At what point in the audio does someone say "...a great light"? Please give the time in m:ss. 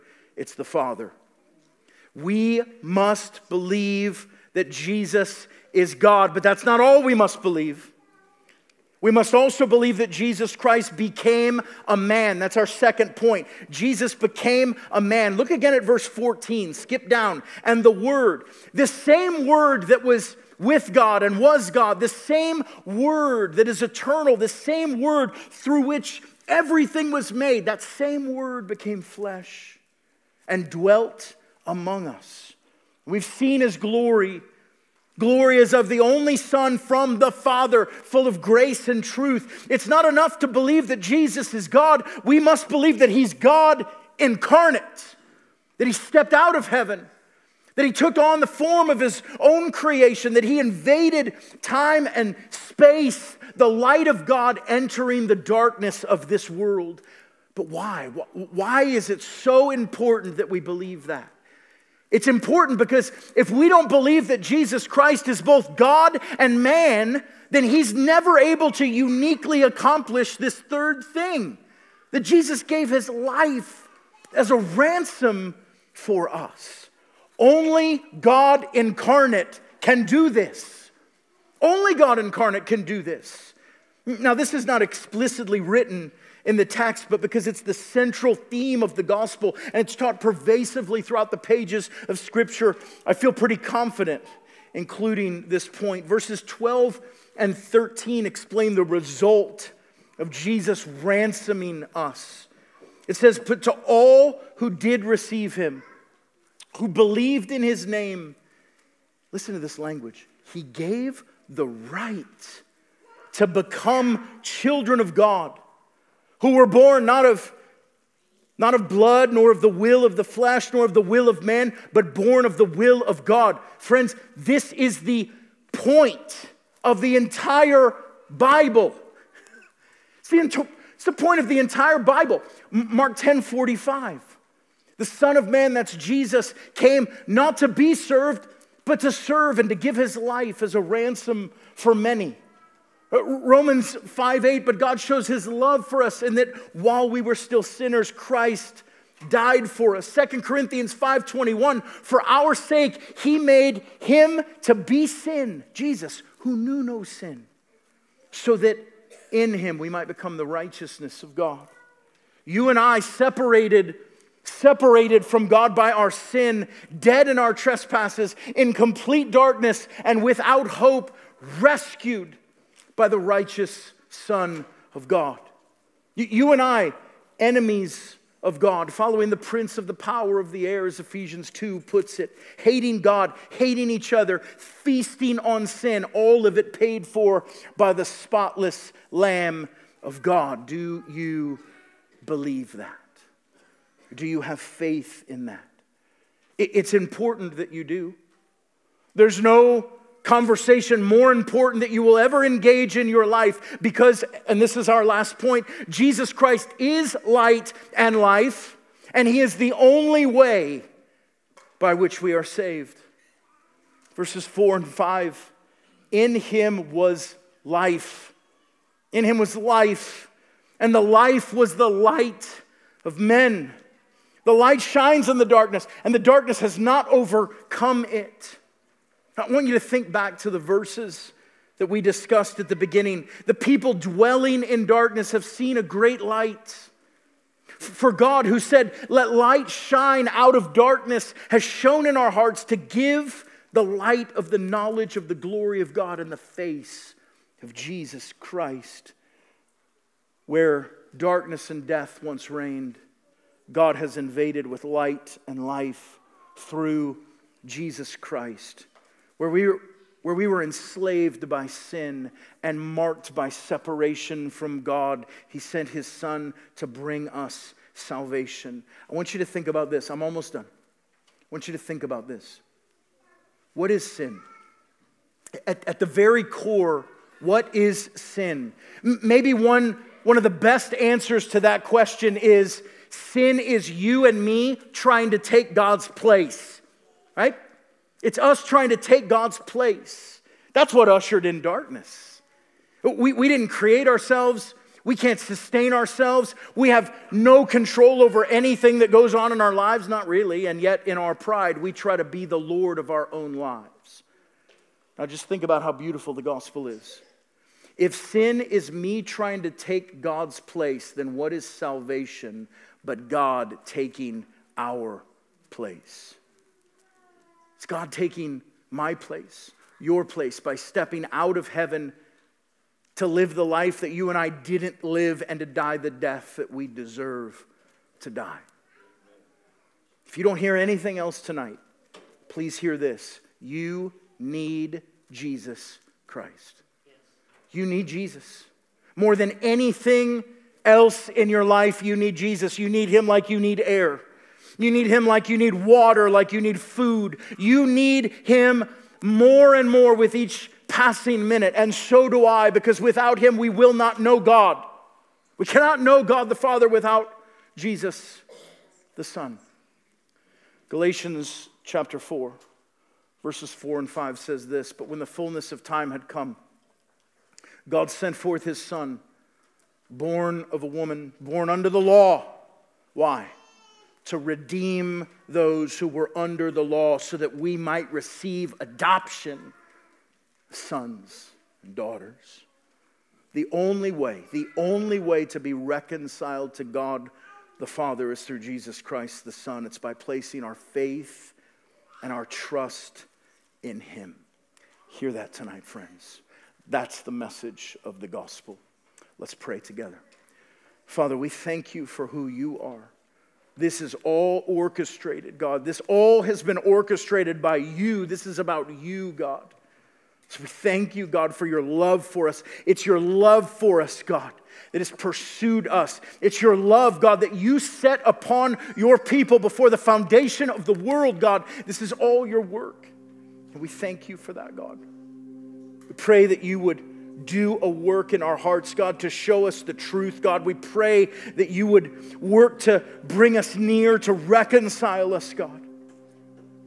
3:55.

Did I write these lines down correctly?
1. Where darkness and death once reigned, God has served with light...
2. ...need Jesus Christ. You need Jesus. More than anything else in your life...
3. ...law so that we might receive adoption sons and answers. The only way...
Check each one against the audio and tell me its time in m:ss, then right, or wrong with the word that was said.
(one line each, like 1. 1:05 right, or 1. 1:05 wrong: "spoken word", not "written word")
1. 4:10 wrong: "invaded", not "served"
2. 5:34 right
3. 6:16 wrong: "daughters", not "answers".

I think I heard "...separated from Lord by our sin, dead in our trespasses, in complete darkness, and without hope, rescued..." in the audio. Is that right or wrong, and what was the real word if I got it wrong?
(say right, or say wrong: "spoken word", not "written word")
wrong: "God", not "Lord".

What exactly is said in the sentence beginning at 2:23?
Uh, Romans 5 8, but God shows his love for us in that while we were still sinners, Christ died for us.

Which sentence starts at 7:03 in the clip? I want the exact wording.
And we thank you for that, God.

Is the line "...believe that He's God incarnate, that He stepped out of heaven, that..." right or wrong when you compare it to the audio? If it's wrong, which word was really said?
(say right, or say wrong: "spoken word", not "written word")
right.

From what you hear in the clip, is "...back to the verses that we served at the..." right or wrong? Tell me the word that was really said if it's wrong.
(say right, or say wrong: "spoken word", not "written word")
wrong: "discussed", not "served".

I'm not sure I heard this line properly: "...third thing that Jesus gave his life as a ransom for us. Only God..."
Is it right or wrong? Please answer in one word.
right.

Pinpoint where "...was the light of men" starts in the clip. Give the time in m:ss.
3:41.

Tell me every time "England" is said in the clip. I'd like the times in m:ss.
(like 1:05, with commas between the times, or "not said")
not said.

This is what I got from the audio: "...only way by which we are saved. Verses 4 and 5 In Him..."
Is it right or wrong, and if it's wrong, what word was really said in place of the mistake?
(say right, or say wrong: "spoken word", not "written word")
right.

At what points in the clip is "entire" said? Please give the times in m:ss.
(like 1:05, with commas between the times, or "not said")
2:07, 2:11.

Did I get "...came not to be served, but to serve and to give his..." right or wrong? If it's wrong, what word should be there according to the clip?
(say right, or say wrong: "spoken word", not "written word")
right.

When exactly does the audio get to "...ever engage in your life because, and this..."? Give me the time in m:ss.
3:22.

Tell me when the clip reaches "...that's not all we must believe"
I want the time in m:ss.
0:06.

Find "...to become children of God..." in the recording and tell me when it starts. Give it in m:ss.
1:53.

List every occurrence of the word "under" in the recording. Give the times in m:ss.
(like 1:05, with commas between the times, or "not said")
6:11, 6:16.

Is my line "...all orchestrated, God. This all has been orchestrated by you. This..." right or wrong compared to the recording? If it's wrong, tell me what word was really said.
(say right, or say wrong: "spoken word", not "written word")
right.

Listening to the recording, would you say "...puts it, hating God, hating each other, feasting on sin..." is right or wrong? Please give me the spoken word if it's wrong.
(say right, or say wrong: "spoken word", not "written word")
right.